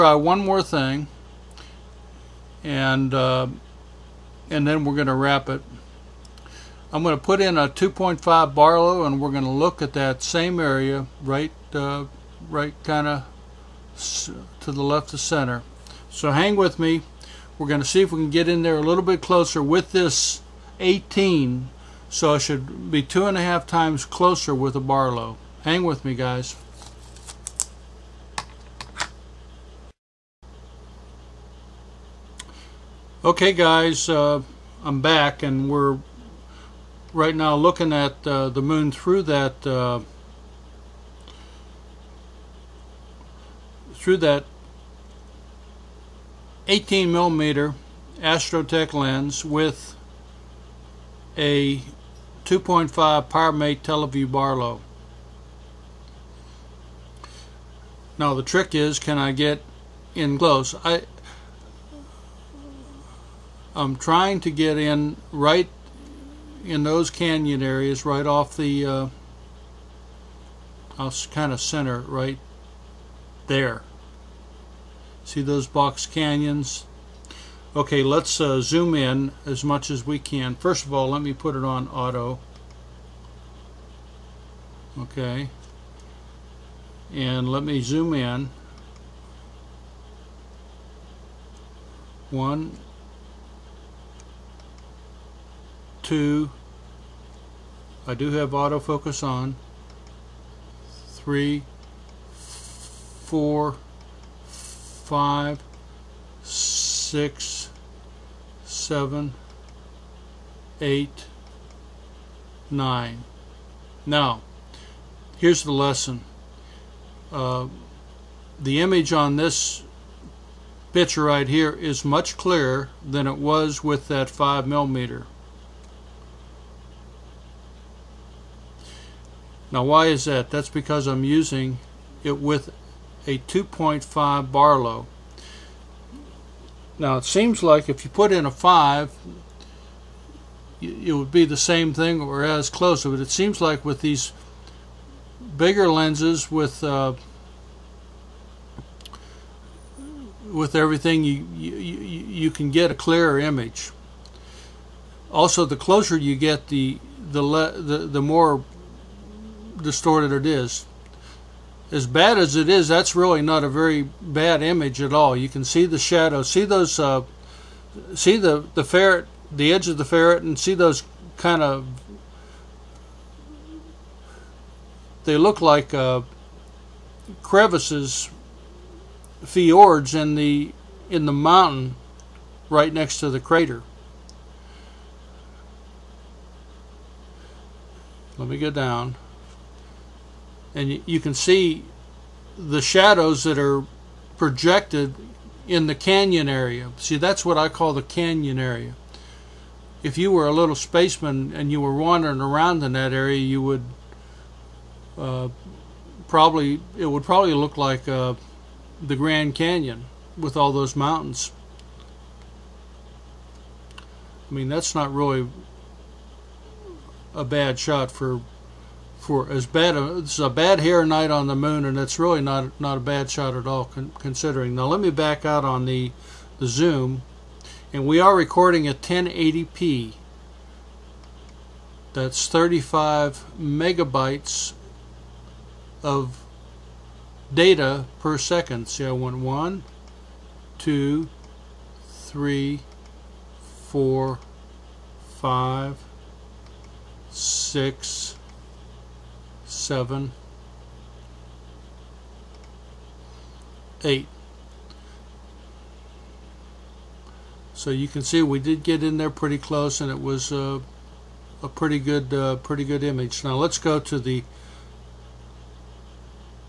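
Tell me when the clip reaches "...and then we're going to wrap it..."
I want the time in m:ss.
0:04.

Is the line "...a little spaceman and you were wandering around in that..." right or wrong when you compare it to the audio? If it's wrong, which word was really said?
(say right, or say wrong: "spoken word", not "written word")
right.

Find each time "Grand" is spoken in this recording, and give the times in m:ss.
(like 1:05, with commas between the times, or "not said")
3:29.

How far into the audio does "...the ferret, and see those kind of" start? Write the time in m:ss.
2:49.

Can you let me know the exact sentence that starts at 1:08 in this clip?
Uh, I'll kind of center right there.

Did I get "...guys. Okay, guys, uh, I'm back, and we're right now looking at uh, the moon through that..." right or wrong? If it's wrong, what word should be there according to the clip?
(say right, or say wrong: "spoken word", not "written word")
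right.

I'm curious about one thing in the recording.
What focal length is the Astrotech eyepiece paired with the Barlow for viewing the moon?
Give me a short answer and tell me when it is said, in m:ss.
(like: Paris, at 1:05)
18 millimeter, at 0:46.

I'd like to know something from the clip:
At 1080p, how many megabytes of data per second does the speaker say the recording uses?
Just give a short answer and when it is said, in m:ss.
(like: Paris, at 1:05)
35, at 3:52.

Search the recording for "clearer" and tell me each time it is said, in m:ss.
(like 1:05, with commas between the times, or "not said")
2:02, 2:32.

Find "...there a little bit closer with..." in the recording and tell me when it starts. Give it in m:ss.
0:18.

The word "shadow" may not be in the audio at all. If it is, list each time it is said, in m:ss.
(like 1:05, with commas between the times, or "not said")
2:45, 3:12.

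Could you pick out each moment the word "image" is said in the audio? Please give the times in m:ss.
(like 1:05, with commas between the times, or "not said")
1:58, 2:33, 2:44, 4:23.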